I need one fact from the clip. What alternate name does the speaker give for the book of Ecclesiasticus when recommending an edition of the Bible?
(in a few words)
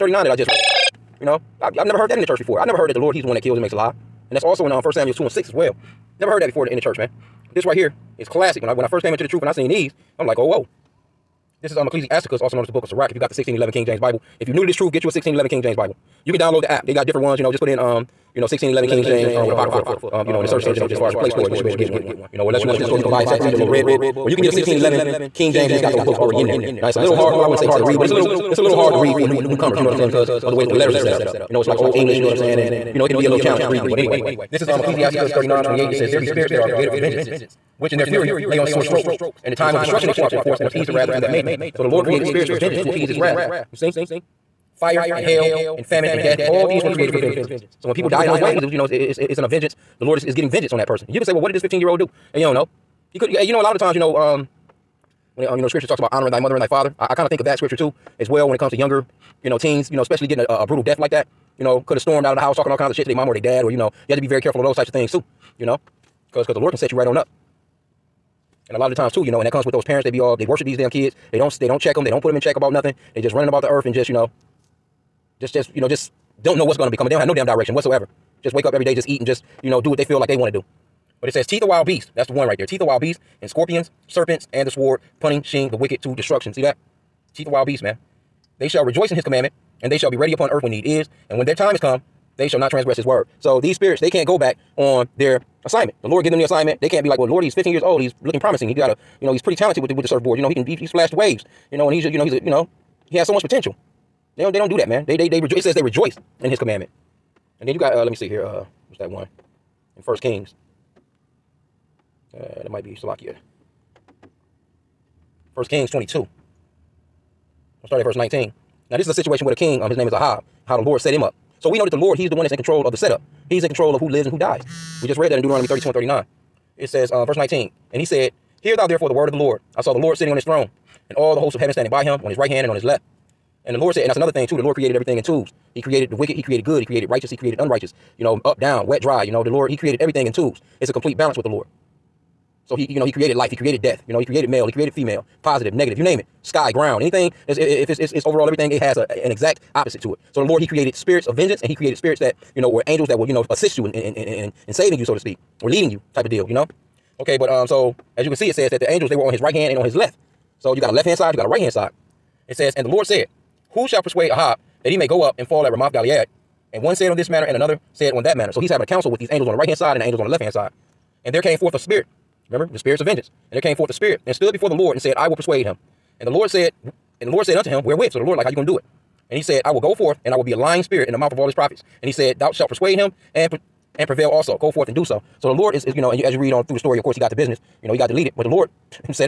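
Book of Sirach.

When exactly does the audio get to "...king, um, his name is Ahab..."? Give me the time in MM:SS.
01:59.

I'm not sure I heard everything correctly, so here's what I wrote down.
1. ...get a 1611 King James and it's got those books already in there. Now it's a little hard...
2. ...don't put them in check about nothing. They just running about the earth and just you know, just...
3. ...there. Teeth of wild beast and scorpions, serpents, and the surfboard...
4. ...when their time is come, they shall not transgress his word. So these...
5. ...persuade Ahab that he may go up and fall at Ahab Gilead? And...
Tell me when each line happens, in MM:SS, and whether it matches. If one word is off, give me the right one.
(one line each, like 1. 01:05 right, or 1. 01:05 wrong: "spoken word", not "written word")
1. 00:24 right
2. 01:12 right
3. 01:22 wrong: "sword", not "surfboard"
4. 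01:31 right
5. 02:44 wrong: "Ramoth", not "Ahab".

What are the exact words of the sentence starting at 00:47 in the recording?
So when people die in those ways, it was you know it's it's it's in a vengeance.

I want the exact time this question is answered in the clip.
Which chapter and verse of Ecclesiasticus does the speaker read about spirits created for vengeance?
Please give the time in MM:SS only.
00:35.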